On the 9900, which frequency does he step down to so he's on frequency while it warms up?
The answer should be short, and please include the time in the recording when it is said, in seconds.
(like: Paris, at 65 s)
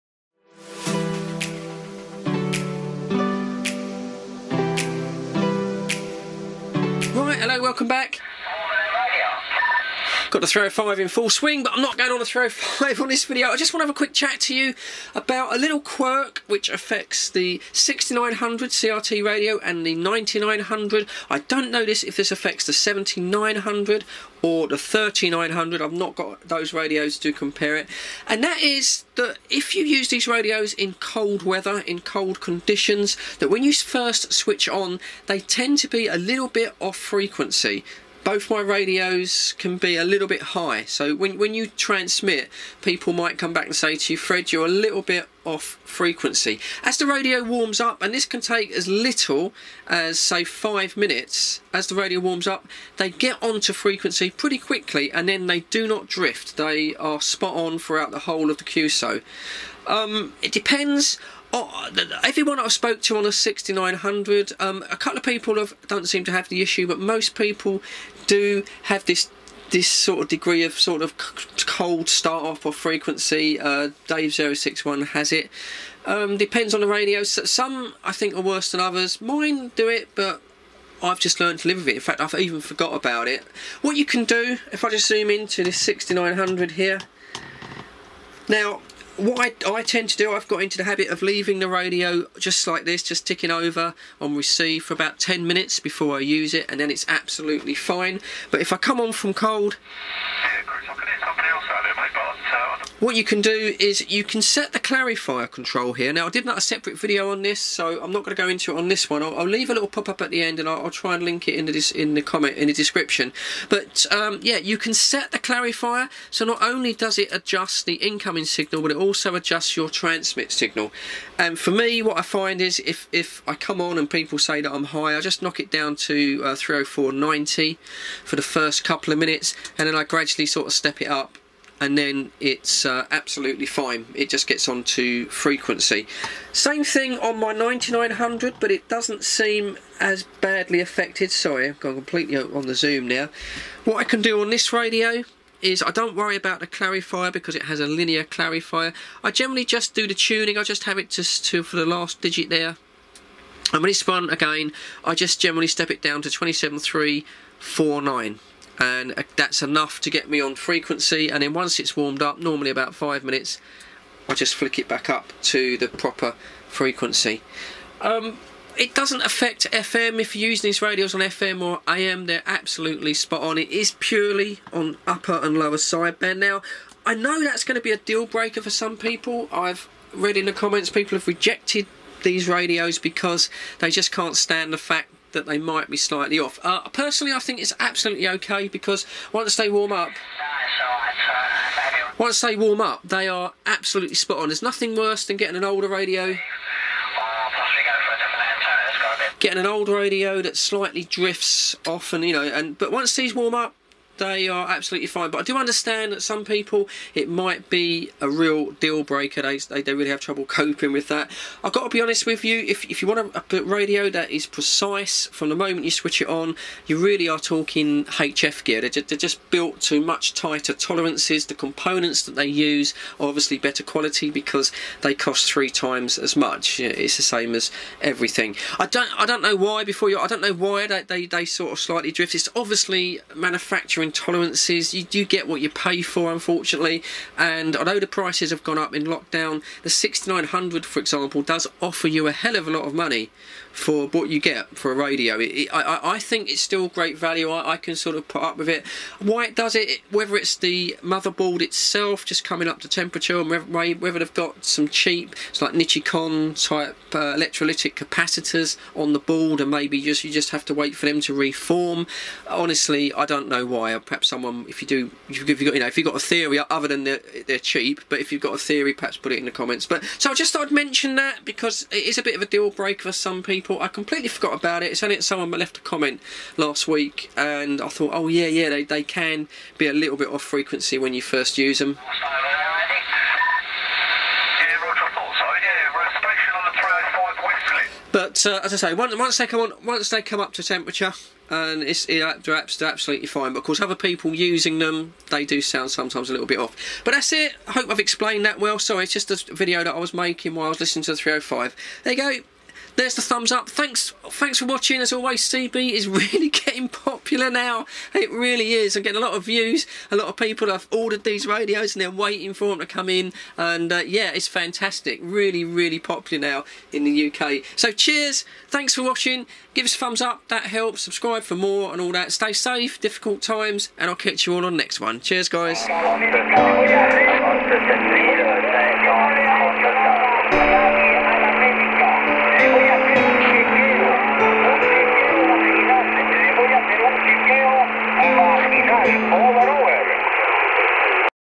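27349, at 156 s.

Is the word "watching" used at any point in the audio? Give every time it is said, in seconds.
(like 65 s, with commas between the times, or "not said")
304 s, 319 s.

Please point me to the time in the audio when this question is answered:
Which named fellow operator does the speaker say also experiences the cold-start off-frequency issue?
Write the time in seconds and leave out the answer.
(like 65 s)
74 s.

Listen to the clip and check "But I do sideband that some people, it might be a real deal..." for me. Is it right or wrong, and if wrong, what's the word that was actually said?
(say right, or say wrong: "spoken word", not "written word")
wrong: "understand", not "sideband".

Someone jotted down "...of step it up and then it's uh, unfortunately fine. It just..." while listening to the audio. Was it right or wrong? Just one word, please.
wrong.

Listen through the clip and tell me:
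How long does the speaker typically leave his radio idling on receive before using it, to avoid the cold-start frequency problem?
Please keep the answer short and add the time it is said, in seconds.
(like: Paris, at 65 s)
10 minutes, at 94 s.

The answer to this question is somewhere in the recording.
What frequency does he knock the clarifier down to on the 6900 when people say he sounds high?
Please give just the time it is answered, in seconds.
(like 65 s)
126 s.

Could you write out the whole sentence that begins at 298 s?
Sorry, it's just a video that I was making while I was listening to the 305.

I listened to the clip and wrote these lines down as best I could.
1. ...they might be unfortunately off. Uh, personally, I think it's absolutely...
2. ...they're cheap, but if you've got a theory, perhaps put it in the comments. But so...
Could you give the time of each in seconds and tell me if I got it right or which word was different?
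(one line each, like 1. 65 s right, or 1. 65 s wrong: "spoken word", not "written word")
1. 185 s wrong: "slightly", not "unfortunately"
2. 267 s right.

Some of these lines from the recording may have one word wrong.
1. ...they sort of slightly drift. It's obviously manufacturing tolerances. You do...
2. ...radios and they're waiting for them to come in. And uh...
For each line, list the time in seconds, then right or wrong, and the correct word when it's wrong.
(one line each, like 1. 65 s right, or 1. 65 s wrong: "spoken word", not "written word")
1. 231 s right
2. 311 s right.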